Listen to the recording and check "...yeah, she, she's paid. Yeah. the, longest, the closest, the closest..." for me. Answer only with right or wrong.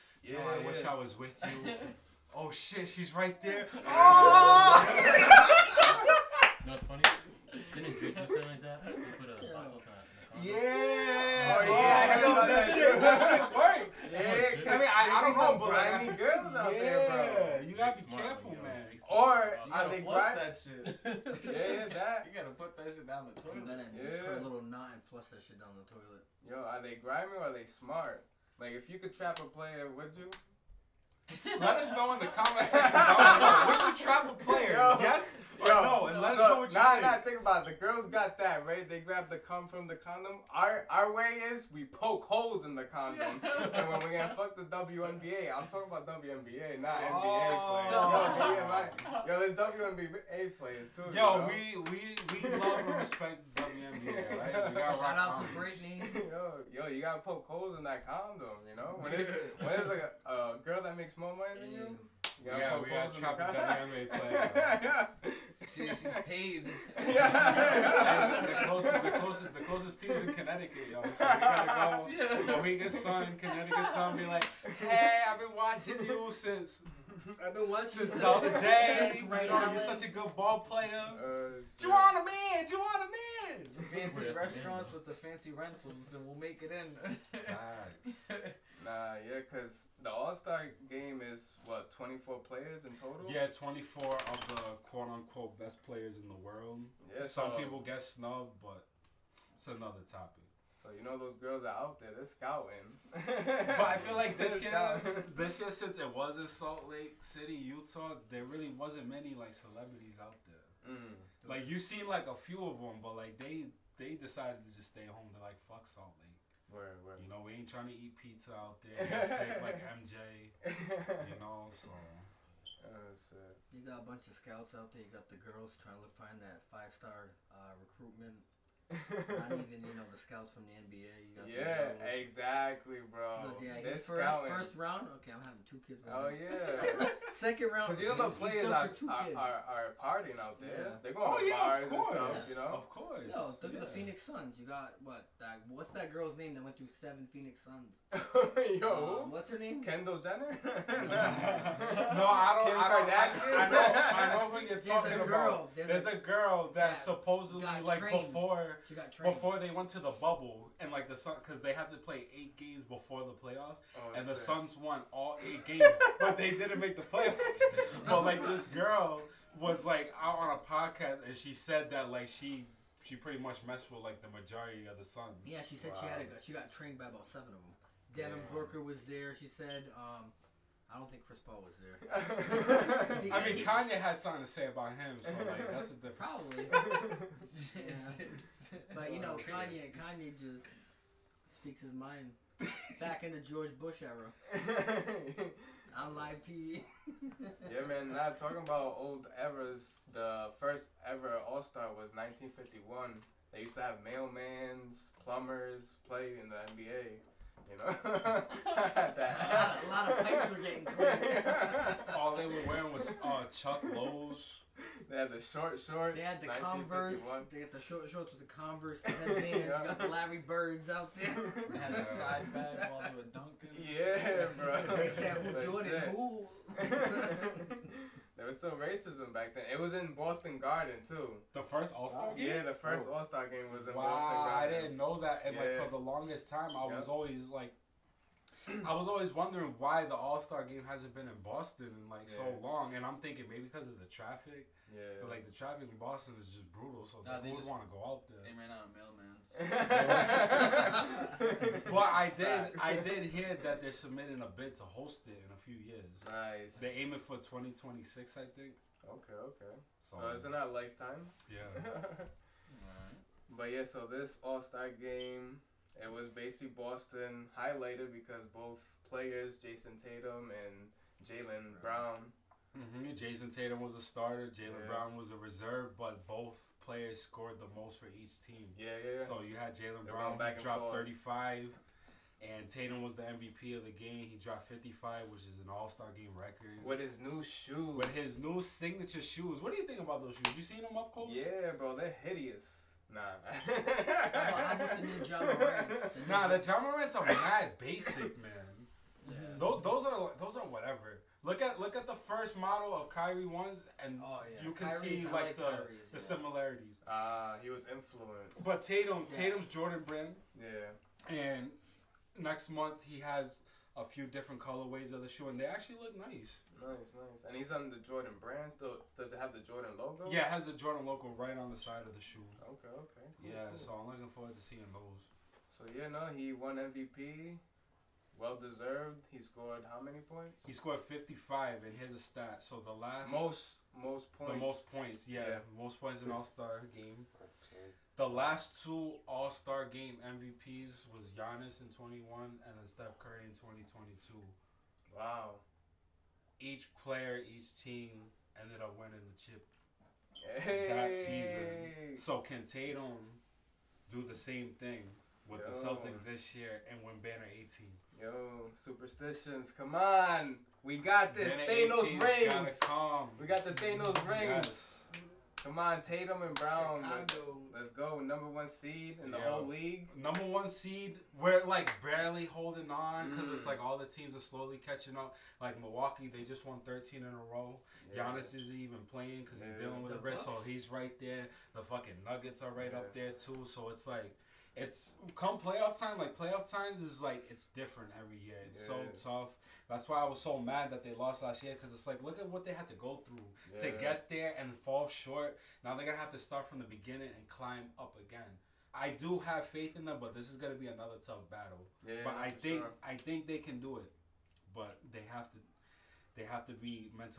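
wrong.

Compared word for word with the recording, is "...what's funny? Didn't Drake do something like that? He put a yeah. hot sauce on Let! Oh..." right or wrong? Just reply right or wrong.
wrong.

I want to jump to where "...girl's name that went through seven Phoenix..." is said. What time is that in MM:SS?
02:26.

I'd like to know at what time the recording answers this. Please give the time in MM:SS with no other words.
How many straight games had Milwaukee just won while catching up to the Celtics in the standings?
06:16.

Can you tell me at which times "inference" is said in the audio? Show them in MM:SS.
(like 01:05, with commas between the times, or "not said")
not said.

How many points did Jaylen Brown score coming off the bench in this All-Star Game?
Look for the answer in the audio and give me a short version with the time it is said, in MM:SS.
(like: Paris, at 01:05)
35, at 04:40.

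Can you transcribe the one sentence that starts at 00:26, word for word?
Yo, are they grimy or are they smart?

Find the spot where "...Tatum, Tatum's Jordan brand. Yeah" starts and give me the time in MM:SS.
05:08.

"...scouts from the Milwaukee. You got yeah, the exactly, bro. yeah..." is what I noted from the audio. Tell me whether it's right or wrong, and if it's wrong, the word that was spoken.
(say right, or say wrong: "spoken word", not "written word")
wrong: "NBA", not "Milwaukee".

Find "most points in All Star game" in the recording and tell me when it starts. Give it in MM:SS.
05:35.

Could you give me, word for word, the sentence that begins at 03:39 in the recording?
got the Larry Birds out there.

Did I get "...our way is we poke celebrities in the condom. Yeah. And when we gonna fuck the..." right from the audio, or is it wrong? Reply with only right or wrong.
wrong.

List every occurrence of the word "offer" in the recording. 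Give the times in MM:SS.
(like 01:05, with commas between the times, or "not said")
not said.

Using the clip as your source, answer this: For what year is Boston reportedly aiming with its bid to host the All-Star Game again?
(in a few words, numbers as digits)
2026.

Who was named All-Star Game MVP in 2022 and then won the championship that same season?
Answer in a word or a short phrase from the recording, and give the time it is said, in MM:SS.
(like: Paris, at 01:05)
Steph Curry, at 05:42.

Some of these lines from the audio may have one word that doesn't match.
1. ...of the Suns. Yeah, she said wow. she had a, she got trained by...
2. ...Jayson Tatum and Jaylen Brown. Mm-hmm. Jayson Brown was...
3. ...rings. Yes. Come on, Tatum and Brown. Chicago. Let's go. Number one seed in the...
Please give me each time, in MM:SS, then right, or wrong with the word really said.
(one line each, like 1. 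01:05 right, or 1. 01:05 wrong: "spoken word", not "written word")
1. 02:54 right
2. 04:29 wrong: "Tatum", not "Brown"
3. 06:04 right.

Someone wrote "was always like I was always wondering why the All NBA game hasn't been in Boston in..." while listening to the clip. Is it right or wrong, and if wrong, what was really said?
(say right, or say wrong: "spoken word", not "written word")
wrong: "Star", not "NBA".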